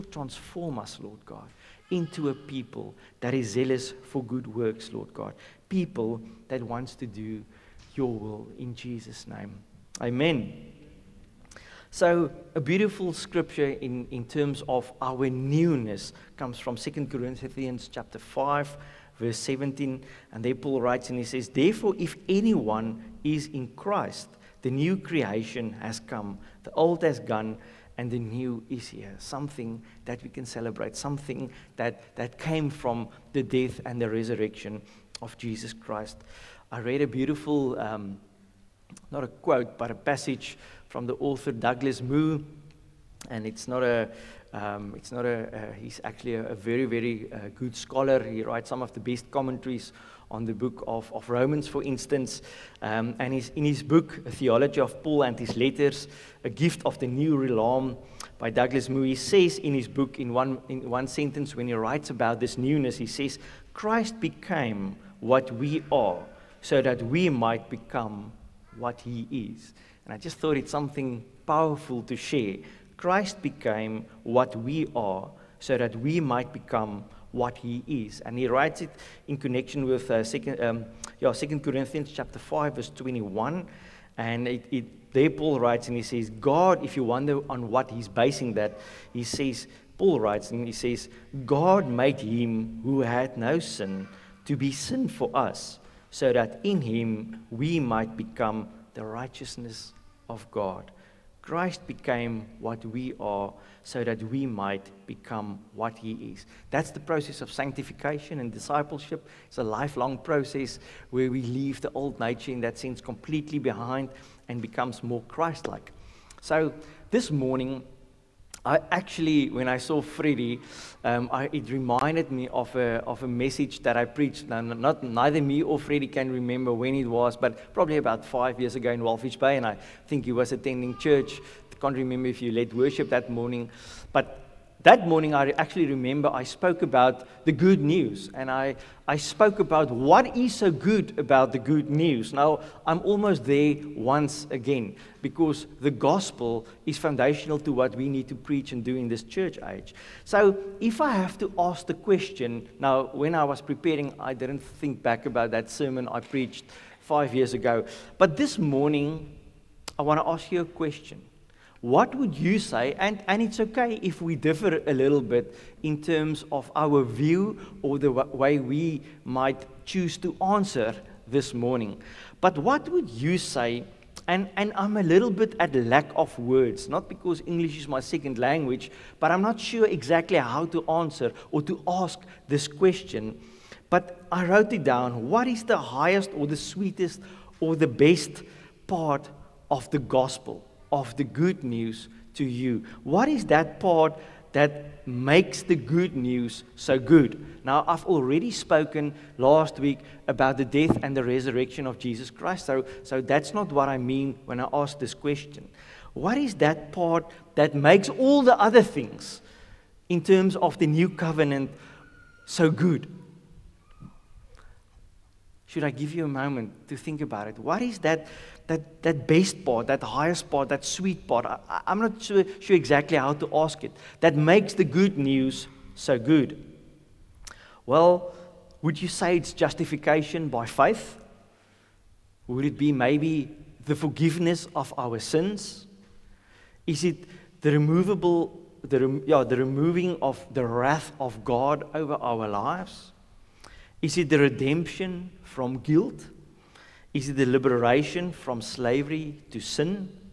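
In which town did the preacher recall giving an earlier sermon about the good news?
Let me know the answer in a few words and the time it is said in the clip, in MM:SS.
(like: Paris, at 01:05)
Walvis Bay, at 02:09.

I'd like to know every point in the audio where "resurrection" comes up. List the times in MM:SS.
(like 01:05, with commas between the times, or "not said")
00:34, 03:21.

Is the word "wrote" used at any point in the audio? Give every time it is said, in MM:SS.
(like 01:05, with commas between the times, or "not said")
03:04.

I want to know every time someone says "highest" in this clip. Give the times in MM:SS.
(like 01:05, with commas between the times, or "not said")
03:05, 03:40.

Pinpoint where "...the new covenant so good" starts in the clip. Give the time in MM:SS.
03:30.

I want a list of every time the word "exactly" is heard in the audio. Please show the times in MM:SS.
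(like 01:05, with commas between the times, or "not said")
02:59, 03:42.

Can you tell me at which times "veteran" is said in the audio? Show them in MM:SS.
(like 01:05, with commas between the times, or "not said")
not said.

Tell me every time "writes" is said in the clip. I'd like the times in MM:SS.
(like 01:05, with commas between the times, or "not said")
00:20, 00:48, 01:01, 01:18, 01:25, 01:30.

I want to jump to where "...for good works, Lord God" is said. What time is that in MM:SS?
00:04.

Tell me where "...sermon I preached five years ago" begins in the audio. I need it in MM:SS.
02:35.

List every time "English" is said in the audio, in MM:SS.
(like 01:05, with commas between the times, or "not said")
02:57.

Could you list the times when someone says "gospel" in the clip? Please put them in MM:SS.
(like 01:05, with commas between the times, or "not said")
02:25, 03:09.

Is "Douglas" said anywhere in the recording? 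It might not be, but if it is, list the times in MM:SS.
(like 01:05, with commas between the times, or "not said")
00:41, 00:58.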